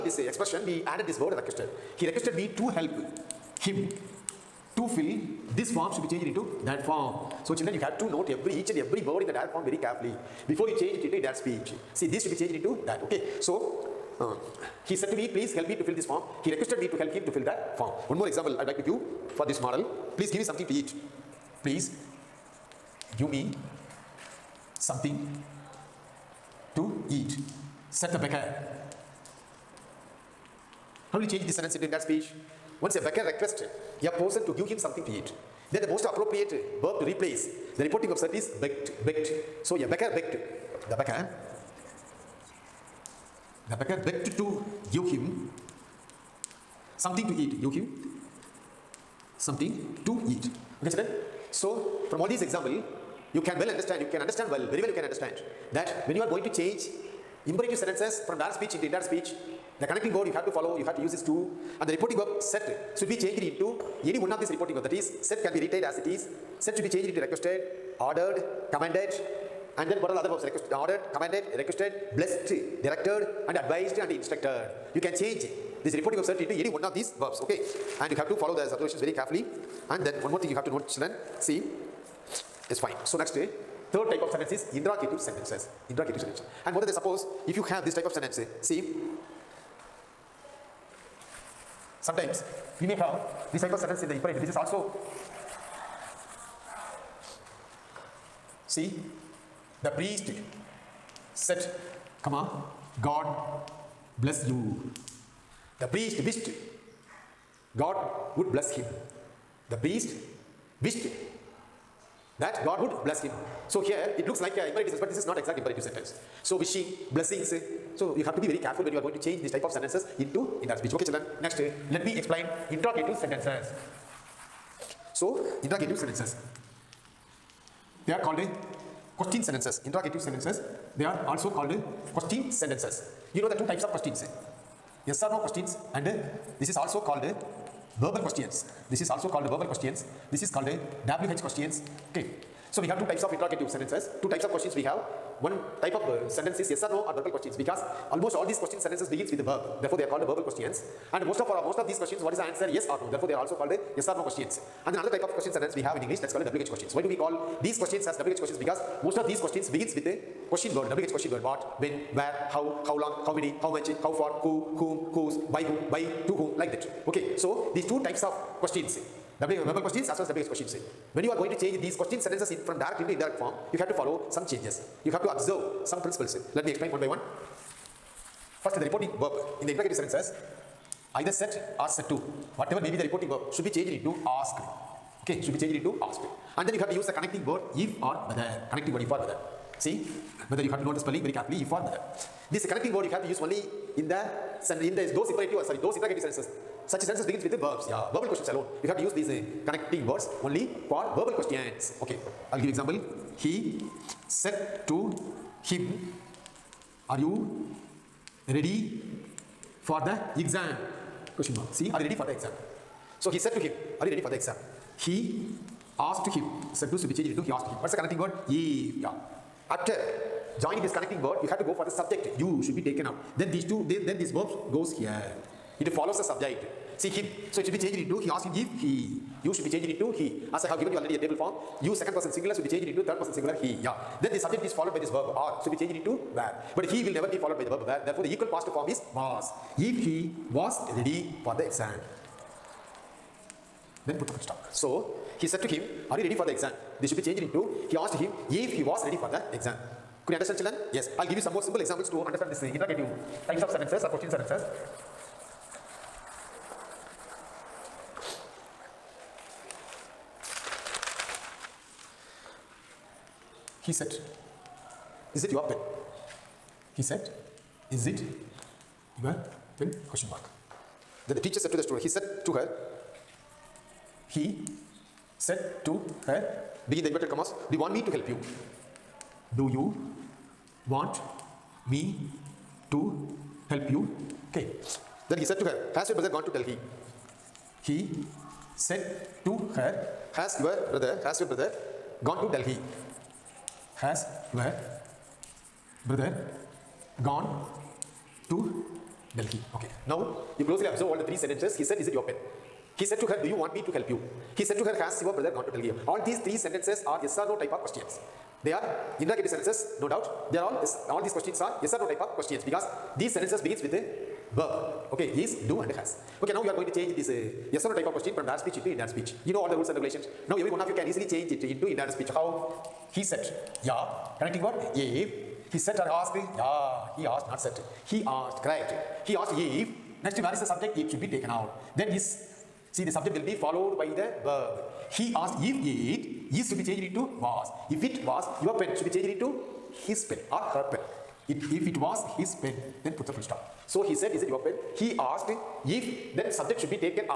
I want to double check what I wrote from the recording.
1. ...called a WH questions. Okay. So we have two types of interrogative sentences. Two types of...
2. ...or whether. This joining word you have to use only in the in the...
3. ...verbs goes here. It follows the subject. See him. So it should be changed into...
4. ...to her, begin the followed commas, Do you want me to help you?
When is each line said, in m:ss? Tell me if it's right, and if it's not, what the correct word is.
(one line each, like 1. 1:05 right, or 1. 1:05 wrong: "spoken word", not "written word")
1. 2:20 right
2. 3:11 wrong: "connecting", not "joining"
3. 3:44 right
4. 4:35 wrong: "inverted", not "followed".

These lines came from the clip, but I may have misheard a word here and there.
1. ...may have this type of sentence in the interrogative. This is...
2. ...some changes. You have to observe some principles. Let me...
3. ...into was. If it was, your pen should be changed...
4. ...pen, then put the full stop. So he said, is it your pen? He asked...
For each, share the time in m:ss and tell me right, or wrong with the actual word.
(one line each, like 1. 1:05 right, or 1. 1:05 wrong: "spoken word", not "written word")
1. 1:32 wrong: "imperative", not "interrogative"
2. 2:54 right
3. 5:37 right
4. 5:42 right.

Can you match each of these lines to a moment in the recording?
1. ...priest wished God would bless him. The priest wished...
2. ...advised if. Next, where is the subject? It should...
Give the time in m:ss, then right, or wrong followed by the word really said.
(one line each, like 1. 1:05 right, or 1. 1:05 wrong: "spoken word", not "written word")
1. 1:45 right
2. 5:29 wrong: "asked", not "advised".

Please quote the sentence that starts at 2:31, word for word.
And most of, for uh, most of these questions, what is the answer?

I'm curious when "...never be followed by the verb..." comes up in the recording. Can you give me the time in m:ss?
3:57.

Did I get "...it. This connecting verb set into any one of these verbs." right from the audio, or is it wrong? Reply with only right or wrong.
wrong.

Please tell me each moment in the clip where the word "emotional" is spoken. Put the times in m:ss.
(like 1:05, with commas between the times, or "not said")
not said.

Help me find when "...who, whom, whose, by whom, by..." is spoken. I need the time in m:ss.
2:44.